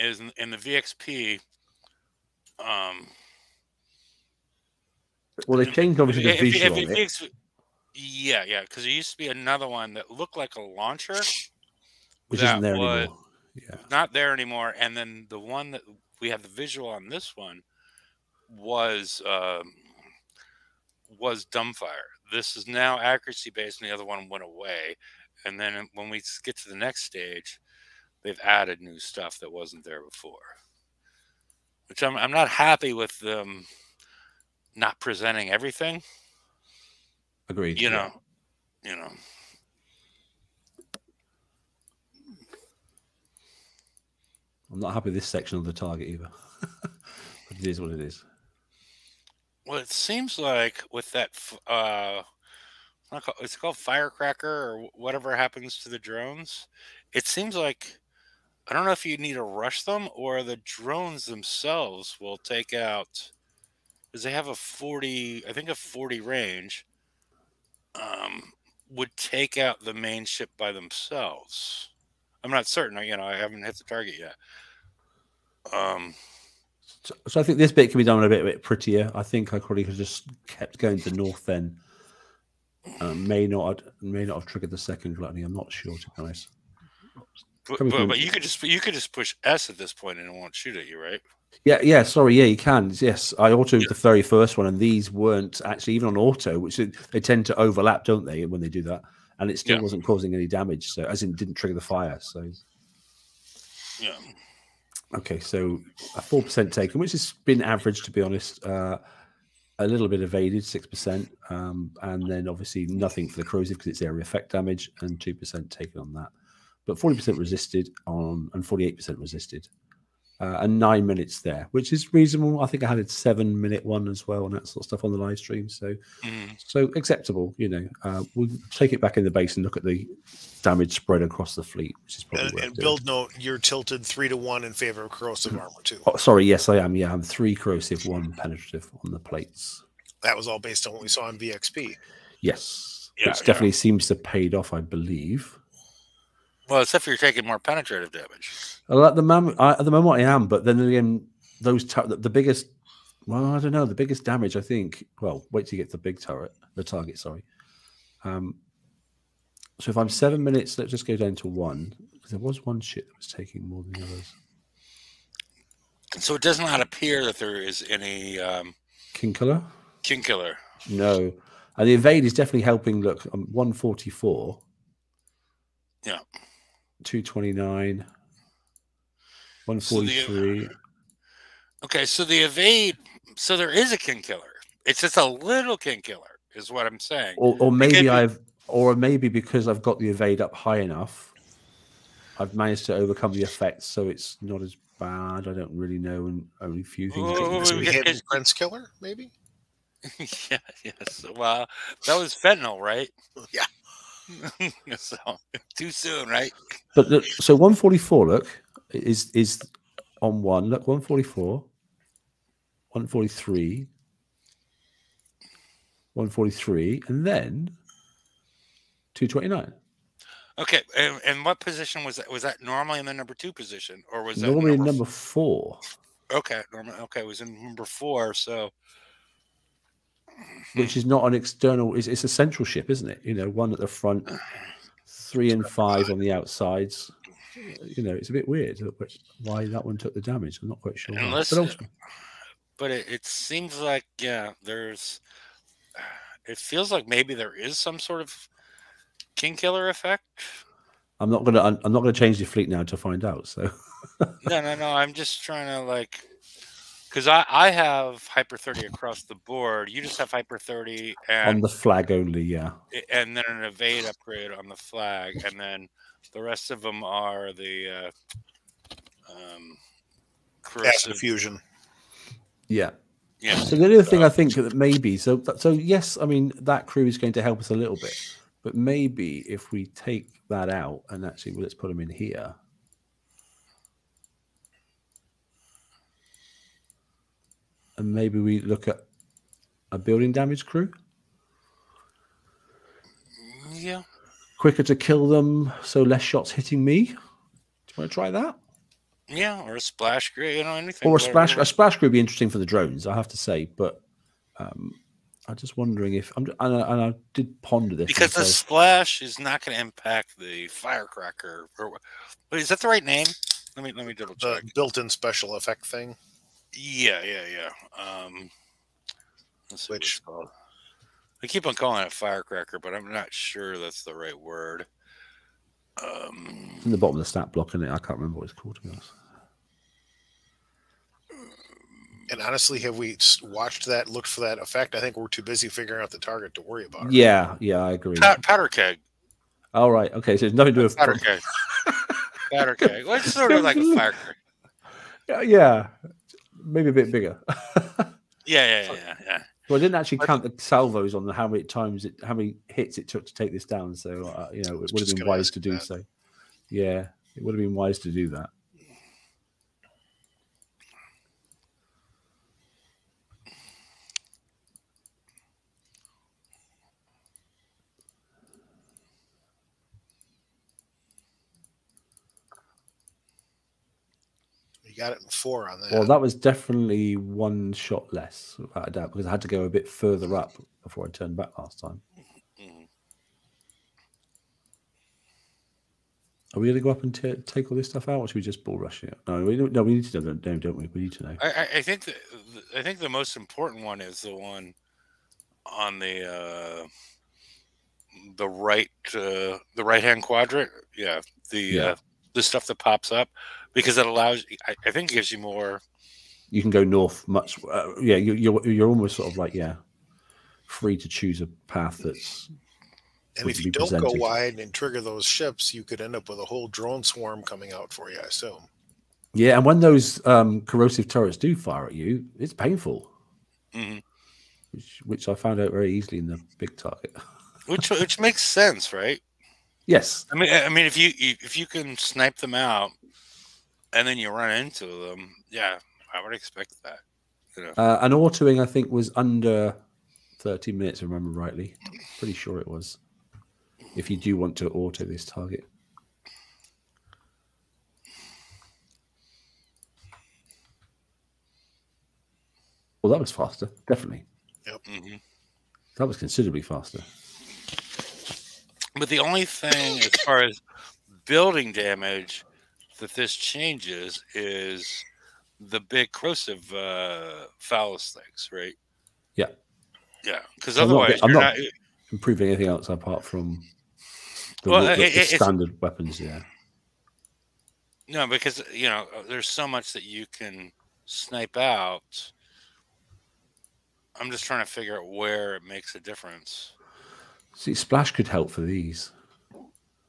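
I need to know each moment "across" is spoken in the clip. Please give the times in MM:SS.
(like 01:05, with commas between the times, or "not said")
02:11, 04:18.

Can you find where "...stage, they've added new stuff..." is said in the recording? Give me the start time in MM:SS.
00:27.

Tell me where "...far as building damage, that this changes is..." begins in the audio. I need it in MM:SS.
07:40.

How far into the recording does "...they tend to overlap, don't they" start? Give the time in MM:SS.
01:36.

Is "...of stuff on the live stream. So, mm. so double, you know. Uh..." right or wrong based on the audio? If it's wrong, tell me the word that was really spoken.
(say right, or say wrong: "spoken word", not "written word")
wrong: "acceptable", not "double".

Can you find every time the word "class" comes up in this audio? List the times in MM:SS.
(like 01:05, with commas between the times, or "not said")
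not said.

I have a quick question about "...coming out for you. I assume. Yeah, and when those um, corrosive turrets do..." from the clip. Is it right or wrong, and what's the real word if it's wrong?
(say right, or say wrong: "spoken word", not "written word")
right.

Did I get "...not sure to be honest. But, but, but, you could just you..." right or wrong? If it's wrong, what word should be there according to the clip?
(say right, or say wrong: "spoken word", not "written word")
right.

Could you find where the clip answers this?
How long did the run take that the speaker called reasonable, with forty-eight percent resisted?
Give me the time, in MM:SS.
02:00.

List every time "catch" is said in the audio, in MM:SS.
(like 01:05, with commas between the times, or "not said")
not said.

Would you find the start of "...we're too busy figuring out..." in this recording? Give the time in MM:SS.
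05:35.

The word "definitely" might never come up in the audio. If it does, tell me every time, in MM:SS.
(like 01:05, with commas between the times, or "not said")
02:23, 02:52, 06:16, 07:33.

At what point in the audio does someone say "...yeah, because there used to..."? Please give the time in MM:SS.
00:08.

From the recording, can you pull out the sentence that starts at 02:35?
Well, wait till you get the big turret, the target.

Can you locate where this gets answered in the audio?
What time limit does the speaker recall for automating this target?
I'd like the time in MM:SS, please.
07:19.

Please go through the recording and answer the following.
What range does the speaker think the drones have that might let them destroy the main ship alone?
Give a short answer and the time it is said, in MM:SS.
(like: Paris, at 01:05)
40, at 01:05.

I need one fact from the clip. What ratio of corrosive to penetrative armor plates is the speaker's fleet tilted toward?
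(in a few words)
3 to 1.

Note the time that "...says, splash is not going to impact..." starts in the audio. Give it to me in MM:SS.
05:08.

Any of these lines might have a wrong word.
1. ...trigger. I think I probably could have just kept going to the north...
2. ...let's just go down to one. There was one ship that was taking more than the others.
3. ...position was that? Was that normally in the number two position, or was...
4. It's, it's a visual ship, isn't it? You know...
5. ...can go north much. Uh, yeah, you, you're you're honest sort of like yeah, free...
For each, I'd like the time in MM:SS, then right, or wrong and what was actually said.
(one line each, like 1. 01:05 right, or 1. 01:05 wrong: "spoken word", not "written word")
1. 01:18 wrong: "prettier", not "trigger"
2. 02:40 right
3. 03:41 right
4. 03:51 wrong: "central", not "visual"
5. 06:46 wrong: "almost", not "honest".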